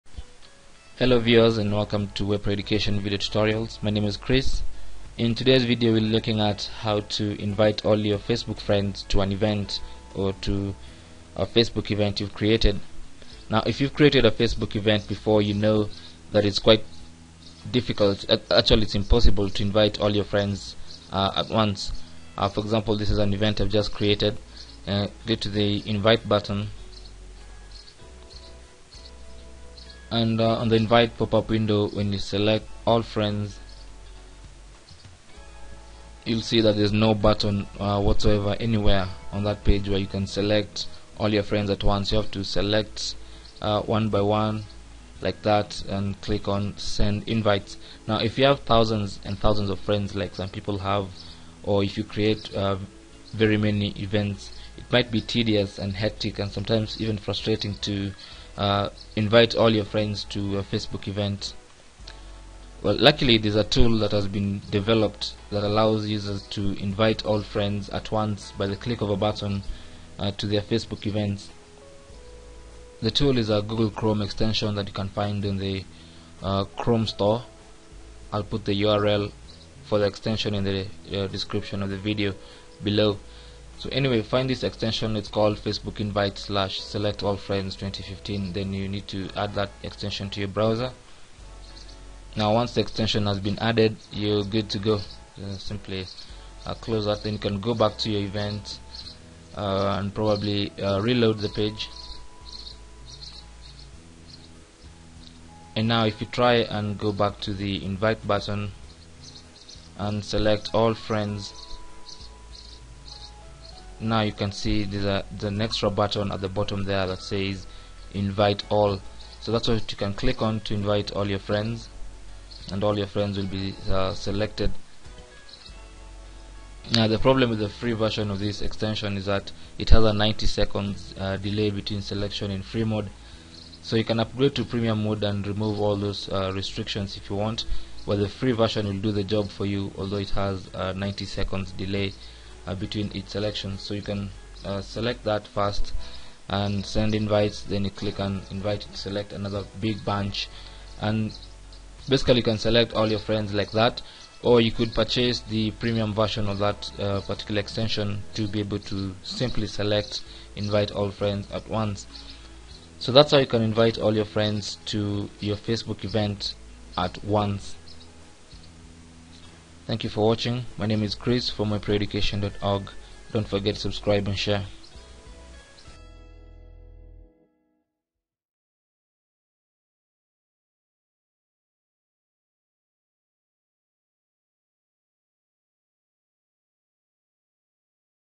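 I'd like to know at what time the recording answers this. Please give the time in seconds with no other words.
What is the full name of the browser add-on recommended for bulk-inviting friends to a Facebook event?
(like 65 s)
85 s.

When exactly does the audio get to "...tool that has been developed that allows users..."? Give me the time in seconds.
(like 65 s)
63 s.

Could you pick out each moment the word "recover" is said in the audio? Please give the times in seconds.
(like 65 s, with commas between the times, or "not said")
not said.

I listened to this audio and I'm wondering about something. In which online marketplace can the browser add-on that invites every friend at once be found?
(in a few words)
Chrome store.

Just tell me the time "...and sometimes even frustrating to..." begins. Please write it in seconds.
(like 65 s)
56 s.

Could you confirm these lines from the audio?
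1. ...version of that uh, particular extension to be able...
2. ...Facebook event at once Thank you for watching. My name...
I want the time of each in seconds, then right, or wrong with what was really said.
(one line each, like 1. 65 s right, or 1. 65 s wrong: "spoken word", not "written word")
1. 156 s right
2. 165 s right.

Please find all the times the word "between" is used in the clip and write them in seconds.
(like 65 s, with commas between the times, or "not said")
131 s, 142 s.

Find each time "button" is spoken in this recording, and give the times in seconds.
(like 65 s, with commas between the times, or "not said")
26 s, 37 s, 69 s, 108 s, 115 s.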